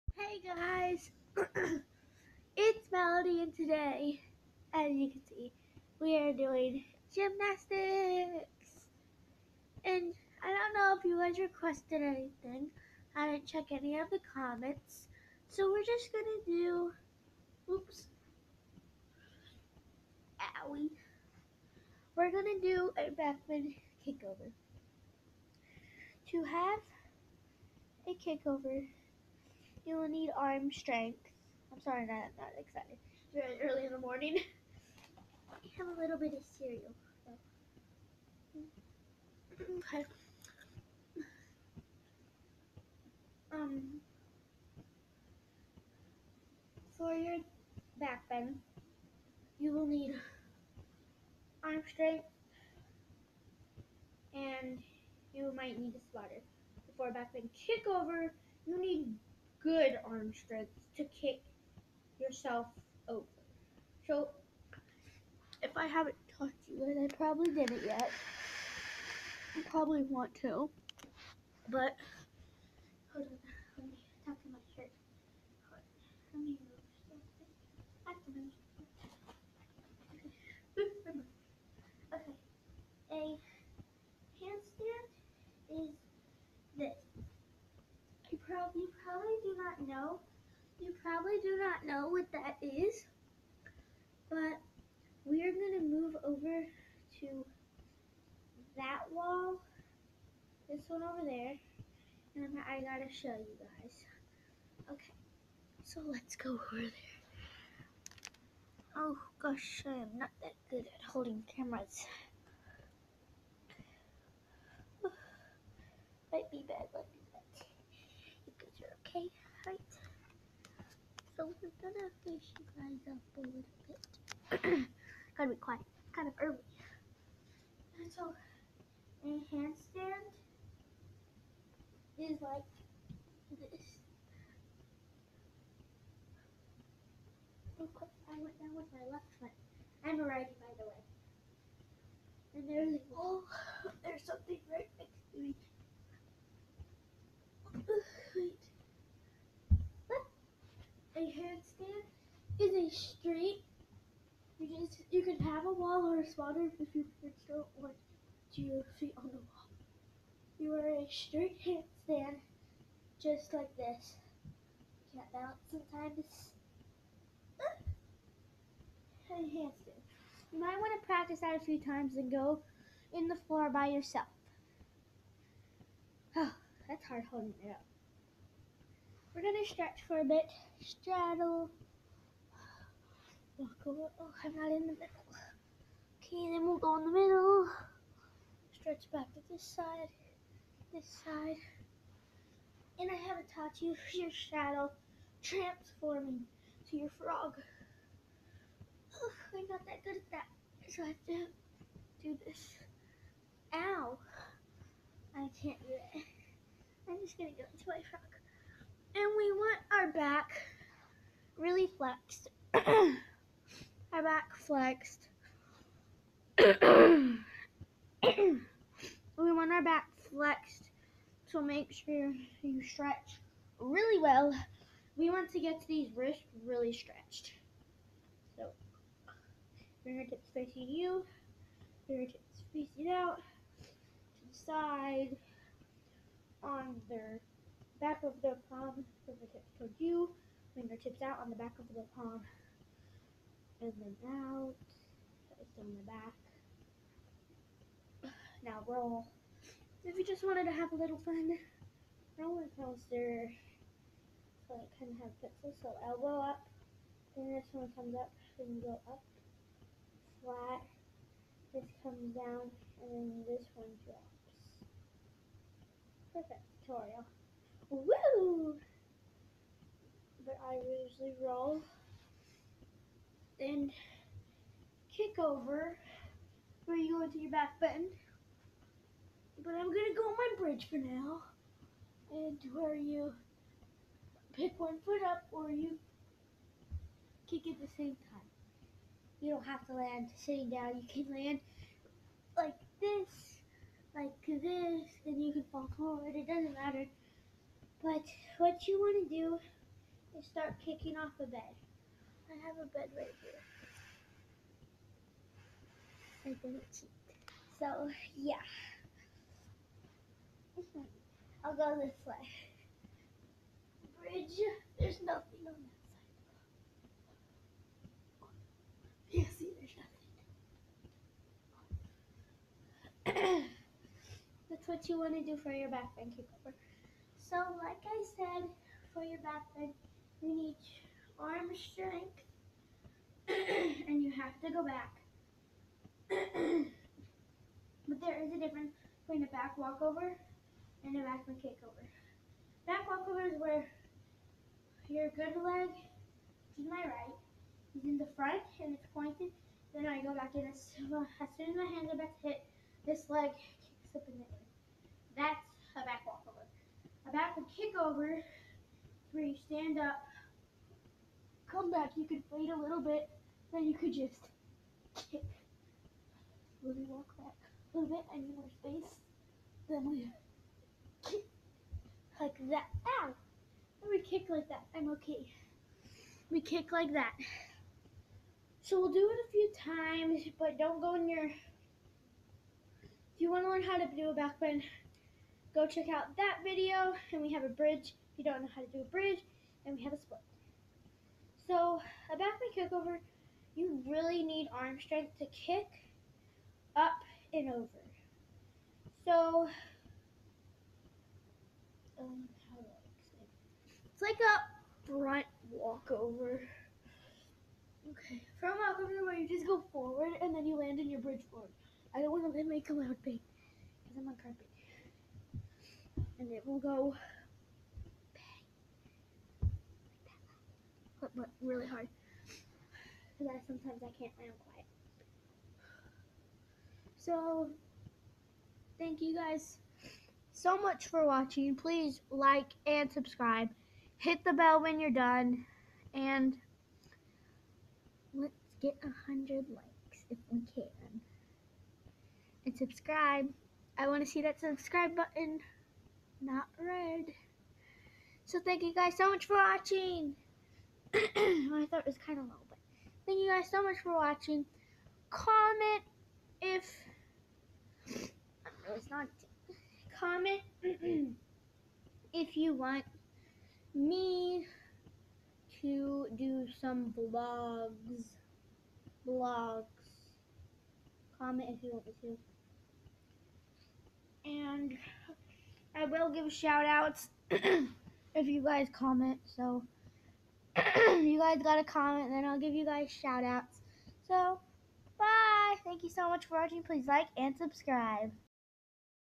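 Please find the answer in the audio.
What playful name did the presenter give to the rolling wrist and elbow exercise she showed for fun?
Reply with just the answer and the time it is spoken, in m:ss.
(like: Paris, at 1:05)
roller coaster, at 4:12.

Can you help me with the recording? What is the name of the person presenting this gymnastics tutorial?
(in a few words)
Melody.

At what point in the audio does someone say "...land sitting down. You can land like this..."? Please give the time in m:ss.
4:49.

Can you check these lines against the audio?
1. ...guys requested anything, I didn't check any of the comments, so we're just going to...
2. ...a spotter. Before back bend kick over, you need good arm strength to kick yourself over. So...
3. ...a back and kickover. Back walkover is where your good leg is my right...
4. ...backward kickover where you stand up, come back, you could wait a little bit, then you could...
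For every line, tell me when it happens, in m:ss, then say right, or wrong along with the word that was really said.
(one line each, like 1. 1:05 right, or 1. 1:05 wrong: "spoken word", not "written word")
1. 0:11 right
2. 0:55 right
3. 5:41 right
4. 5:57 right.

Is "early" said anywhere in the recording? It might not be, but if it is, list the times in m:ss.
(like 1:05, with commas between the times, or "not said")
0:33, 2:06.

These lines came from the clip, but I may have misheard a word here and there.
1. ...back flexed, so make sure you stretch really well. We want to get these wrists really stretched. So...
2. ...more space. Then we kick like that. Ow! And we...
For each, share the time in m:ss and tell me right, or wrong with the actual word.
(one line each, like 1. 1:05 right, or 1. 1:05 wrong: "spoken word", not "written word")
1. 3:39 right
2. 6:08 right.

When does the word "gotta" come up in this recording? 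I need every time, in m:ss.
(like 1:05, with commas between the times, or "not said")
1:42, 2:05.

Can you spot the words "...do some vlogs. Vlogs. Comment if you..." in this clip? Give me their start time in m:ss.
7:46.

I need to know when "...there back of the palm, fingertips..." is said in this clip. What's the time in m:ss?
3:57.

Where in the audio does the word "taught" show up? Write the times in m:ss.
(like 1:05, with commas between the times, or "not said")
1:06, 3:13.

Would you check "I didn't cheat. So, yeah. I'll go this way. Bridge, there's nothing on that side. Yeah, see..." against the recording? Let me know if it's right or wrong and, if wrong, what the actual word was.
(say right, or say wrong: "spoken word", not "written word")
right.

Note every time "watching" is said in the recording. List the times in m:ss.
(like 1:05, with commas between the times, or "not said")
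7:11, 7:29, 7:34, 8:06.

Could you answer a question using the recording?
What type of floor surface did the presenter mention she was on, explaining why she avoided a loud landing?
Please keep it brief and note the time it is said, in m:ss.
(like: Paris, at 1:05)
carpet, at 6:54.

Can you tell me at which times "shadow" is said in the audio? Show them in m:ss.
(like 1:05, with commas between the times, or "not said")
3:14.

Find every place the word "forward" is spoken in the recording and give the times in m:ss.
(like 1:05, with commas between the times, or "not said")
4:55, 6:49.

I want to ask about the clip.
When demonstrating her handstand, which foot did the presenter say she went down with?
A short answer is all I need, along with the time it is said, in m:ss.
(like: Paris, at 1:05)
left foot, at 2:19.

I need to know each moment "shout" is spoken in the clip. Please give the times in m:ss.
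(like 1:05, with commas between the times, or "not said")
7:56, 8:03.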